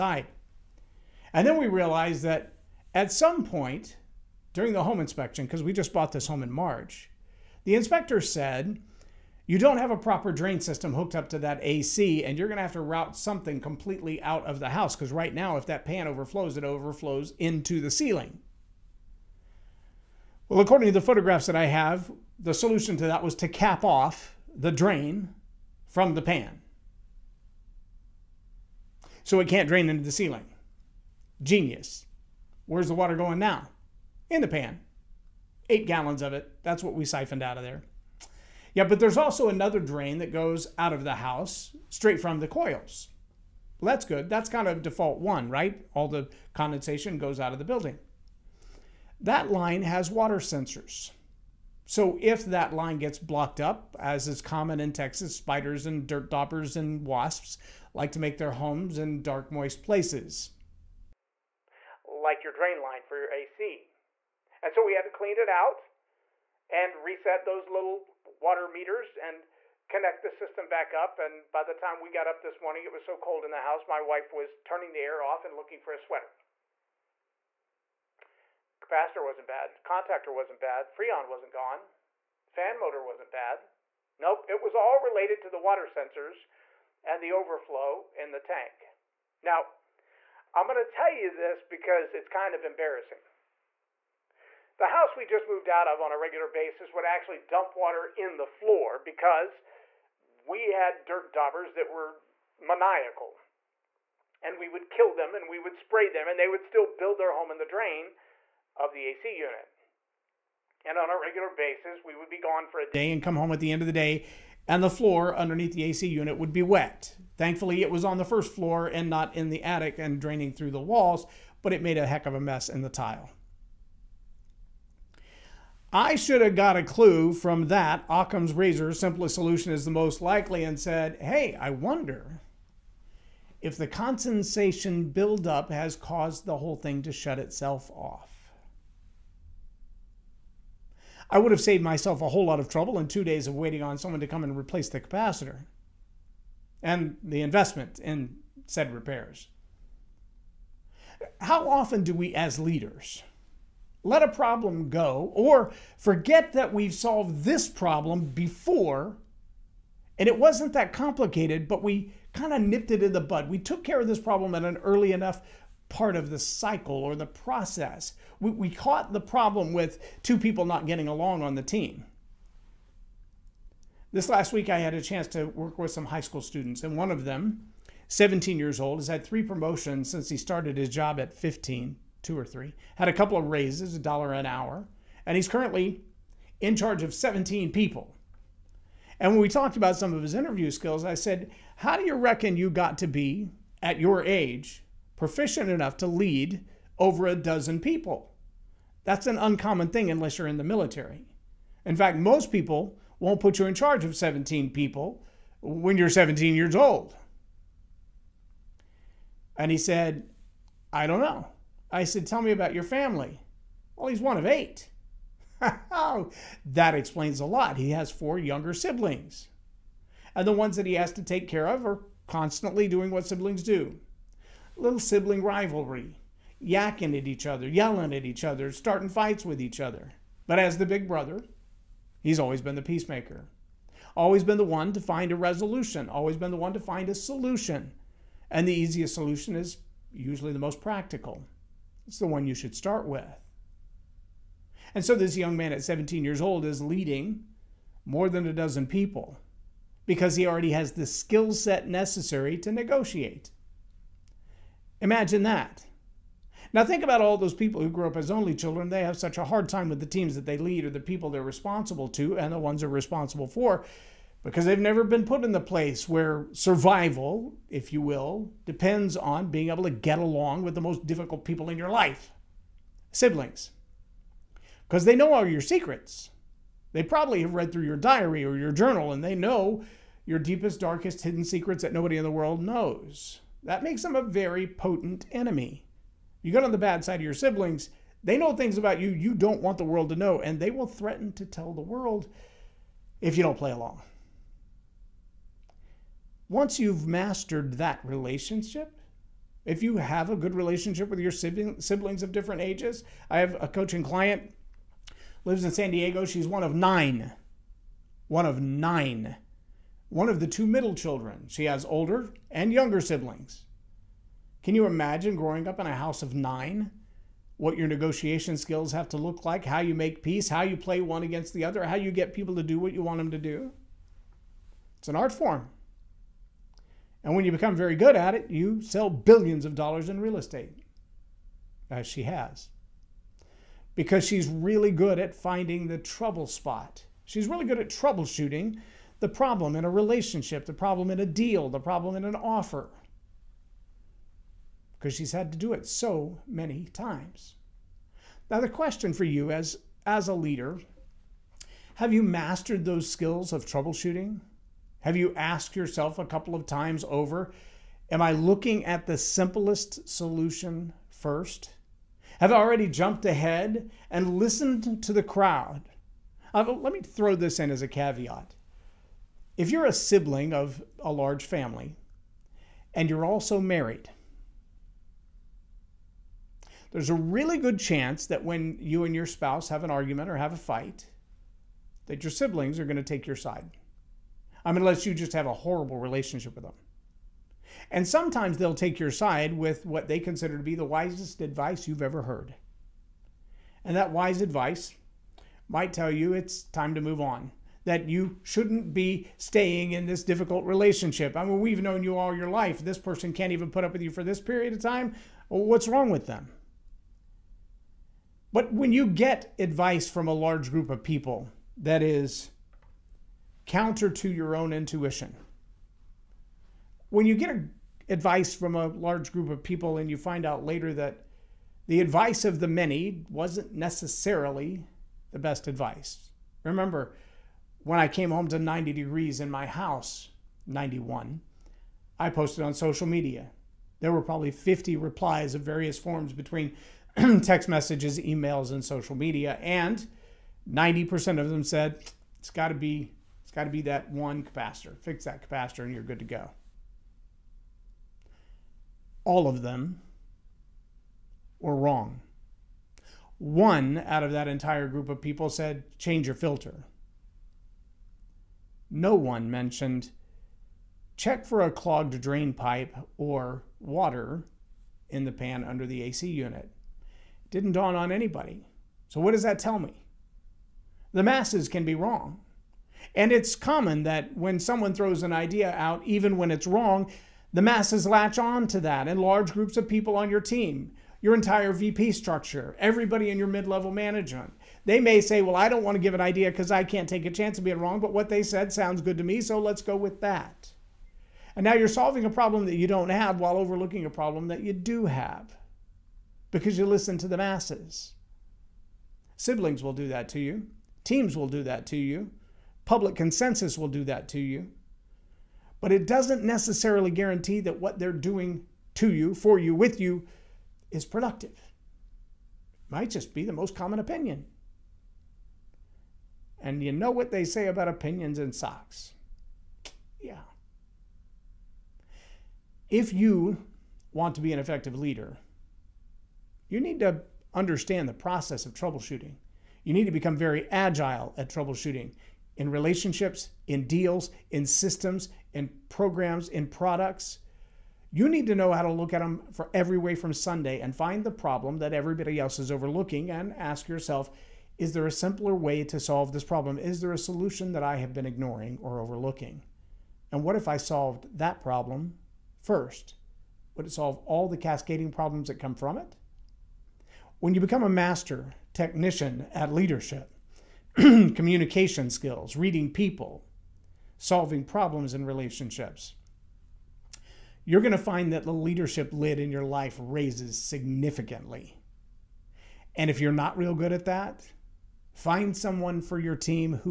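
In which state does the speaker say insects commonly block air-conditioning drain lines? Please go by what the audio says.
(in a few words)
Texas.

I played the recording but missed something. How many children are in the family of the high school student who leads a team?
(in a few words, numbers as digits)
8.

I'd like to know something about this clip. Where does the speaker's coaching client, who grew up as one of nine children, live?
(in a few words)
San Diego.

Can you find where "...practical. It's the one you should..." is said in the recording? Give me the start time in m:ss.
4:00.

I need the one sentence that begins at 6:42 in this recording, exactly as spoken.
This person can't even put up with you for this period of time.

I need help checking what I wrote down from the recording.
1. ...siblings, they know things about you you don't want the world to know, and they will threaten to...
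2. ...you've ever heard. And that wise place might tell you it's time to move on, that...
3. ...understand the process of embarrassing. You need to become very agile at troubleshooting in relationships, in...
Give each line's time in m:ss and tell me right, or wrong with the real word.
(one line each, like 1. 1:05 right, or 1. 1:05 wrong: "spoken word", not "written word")
1. 4:47 right
2. 6:31 wrong: "advice", not "place"
3. 8:47 wrong: "troubleshooting", not "embarrassing".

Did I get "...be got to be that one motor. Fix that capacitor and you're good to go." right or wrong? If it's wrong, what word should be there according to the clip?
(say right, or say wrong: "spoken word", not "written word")
wrong: "capacitor", not "motor".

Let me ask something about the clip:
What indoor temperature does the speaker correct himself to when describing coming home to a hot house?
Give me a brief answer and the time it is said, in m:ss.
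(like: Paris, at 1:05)
91, at 7:10.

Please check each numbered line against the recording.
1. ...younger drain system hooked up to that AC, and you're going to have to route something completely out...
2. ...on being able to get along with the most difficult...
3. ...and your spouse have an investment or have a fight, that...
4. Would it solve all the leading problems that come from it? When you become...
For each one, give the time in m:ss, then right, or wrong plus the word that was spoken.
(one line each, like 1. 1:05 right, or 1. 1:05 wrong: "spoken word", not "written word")
1. 0:09 wrong: "proper", not "younger"
2. 4:29 right
3. 6:19 wrong: "argument", not "investment"
4. 9:13 wrong: "cascading", not "leading".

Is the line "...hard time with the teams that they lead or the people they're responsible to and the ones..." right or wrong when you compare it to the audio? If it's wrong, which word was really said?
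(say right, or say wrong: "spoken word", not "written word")
right.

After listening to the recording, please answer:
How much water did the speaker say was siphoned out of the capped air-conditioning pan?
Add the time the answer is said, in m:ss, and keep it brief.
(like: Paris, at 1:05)
8 gallons, at 0:35.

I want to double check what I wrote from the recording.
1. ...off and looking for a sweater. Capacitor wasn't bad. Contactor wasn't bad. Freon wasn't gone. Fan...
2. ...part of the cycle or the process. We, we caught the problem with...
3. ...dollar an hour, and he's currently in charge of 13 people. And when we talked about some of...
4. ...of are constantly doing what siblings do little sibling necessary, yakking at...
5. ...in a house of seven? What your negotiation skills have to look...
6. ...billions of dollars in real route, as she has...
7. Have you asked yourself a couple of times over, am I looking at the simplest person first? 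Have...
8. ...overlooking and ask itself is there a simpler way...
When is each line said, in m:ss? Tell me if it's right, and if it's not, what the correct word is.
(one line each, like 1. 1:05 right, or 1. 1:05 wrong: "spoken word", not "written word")
1. 1:15 right
2. 2:45 right
3. 3:04 wrong: "17", not "13"
4. 3:41 wrong: "rivalry", not "necessary"
5. 5:15 wrong: "nine", not "seven"
6. 5:29 wrong: "estate", not "route"
7. 5:55 wrong: "solution", not "person"
8. 9:02 wrong: "yourself", not "itself".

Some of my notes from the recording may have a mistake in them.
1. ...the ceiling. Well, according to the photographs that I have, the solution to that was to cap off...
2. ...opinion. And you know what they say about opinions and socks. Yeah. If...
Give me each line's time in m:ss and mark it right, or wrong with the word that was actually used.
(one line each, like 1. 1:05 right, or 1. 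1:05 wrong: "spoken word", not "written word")
1. 0:17 right
2. 8:33 right.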